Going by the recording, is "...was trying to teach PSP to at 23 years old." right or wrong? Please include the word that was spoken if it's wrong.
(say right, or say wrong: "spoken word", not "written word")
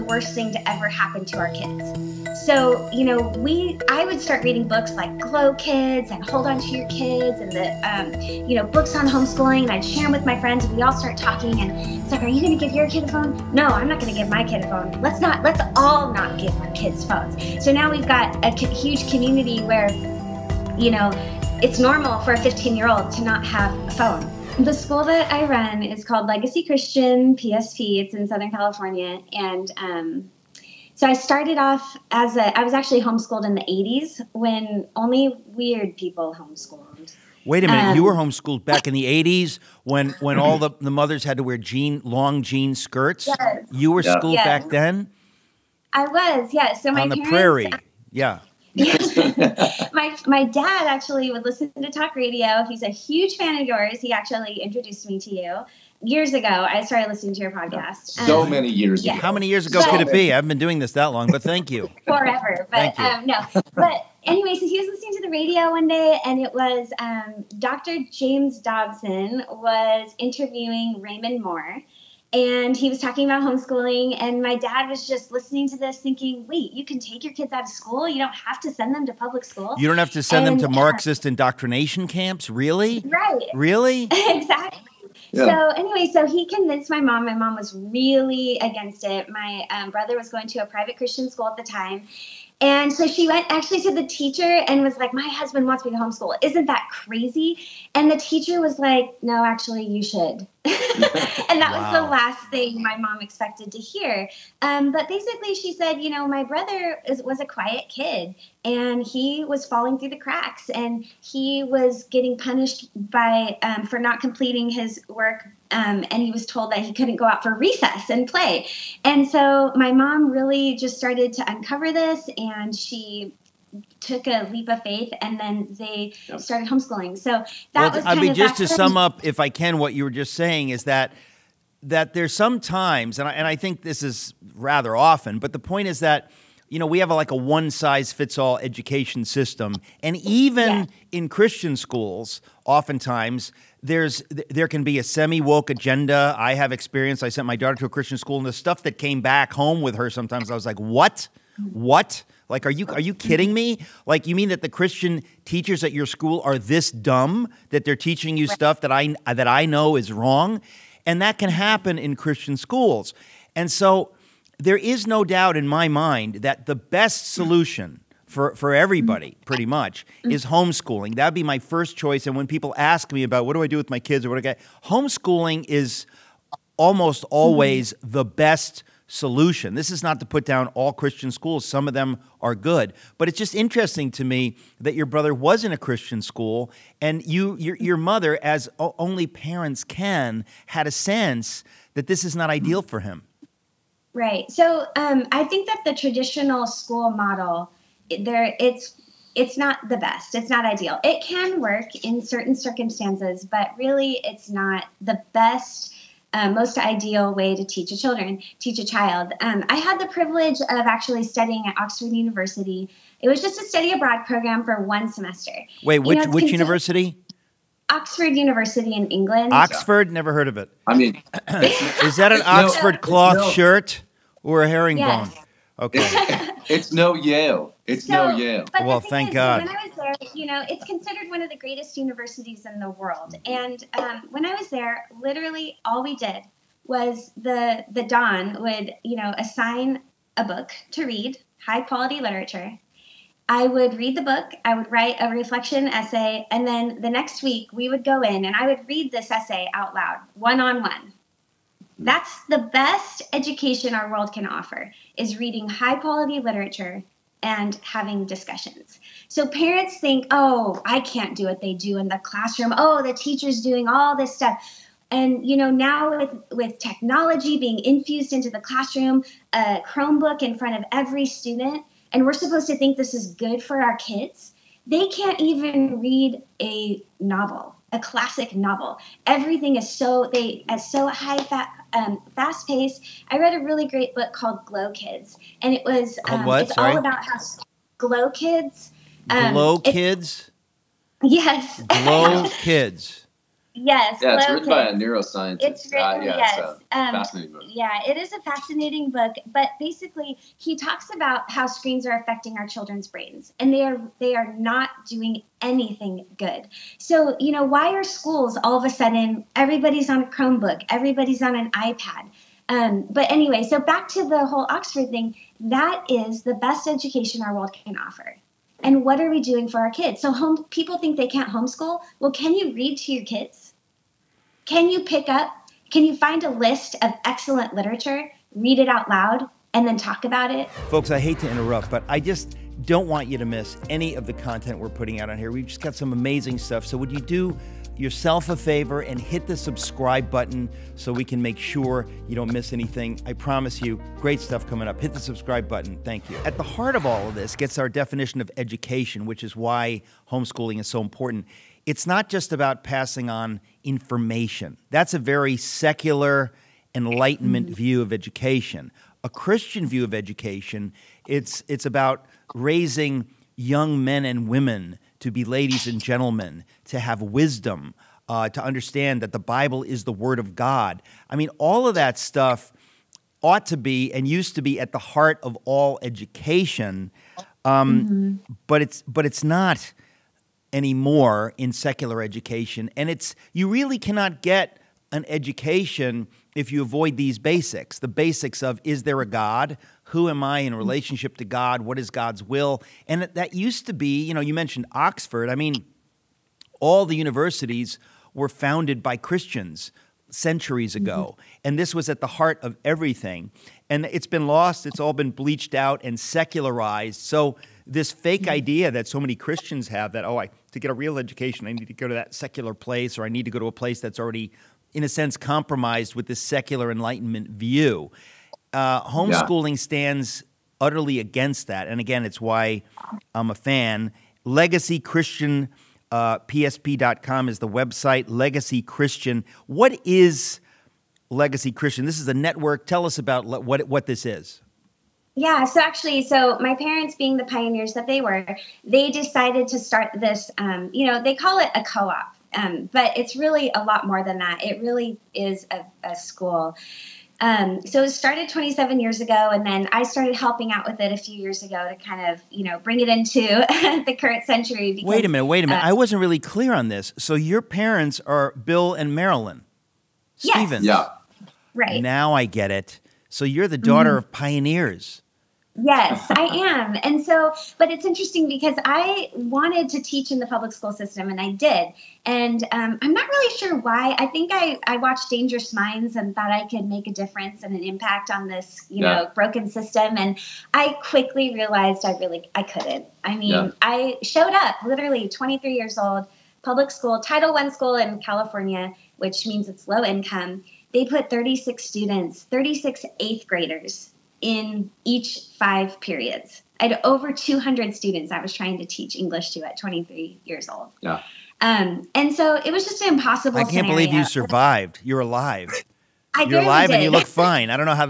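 wrong: "English", not "PSP".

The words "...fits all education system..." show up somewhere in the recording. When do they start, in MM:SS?
02:18.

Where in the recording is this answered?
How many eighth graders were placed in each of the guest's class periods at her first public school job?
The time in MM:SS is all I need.
08:12.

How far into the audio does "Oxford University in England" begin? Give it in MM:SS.
03:37.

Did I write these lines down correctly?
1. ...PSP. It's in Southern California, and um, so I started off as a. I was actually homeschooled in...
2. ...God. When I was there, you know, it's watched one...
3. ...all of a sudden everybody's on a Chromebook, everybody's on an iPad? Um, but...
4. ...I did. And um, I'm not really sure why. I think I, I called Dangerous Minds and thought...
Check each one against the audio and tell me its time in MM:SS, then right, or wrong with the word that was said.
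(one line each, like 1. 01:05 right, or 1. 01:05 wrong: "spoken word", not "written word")
1. 00:27 right
2. 03:49 wrong: "considered", not "watched"
3. 05:08 right
4. 07:51 wrong: "watched", not "called".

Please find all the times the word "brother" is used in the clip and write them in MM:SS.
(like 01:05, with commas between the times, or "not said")
01:29, 01:46, 03:05.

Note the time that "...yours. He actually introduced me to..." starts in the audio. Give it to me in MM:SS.
00:53.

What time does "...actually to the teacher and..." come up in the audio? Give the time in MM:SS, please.
01:33.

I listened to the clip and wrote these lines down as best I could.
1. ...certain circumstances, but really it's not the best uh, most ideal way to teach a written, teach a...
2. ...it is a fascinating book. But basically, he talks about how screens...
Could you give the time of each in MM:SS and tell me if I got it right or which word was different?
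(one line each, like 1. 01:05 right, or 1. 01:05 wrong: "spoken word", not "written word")
1. 03:22 wrong: "children", not "written"
2. 04:58 right.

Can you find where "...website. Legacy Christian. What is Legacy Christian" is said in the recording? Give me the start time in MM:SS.
07:07.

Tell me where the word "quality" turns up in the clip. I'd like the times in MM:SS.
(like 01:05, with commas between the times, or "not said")
04:01, 04:15.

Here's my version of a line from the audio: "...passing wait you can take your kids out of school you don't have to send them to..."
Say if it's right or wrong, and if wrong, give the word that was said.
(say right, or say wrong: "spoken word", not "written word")
wrong: "thinking", not "passing".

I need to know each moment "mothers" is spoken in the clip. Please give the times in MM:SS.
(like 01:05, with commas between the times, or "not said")
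00:40, 03:07.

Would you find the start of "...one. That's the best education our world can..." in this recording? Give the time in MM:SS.
04:10.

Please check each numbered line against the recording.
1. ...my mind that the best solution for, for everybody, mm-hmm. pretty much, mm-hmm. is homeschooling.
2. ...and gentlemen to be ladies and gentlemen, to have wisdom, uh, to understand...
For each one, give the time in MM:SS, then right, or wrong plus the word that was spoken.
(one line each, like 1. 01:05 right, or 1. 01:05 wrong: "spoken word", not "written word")
1. 02:45 right
2. 06:04 wrong: "women", not "gentlemen".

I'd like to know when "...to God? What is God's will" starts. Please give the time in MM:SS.
06:31.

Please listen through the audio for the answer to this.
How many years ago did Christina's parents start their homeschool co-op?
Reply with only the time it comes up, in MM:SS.
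07:28.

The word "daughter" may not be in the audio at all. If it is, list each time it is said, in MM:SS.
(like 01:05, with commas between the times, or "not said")
02:27, 07:43.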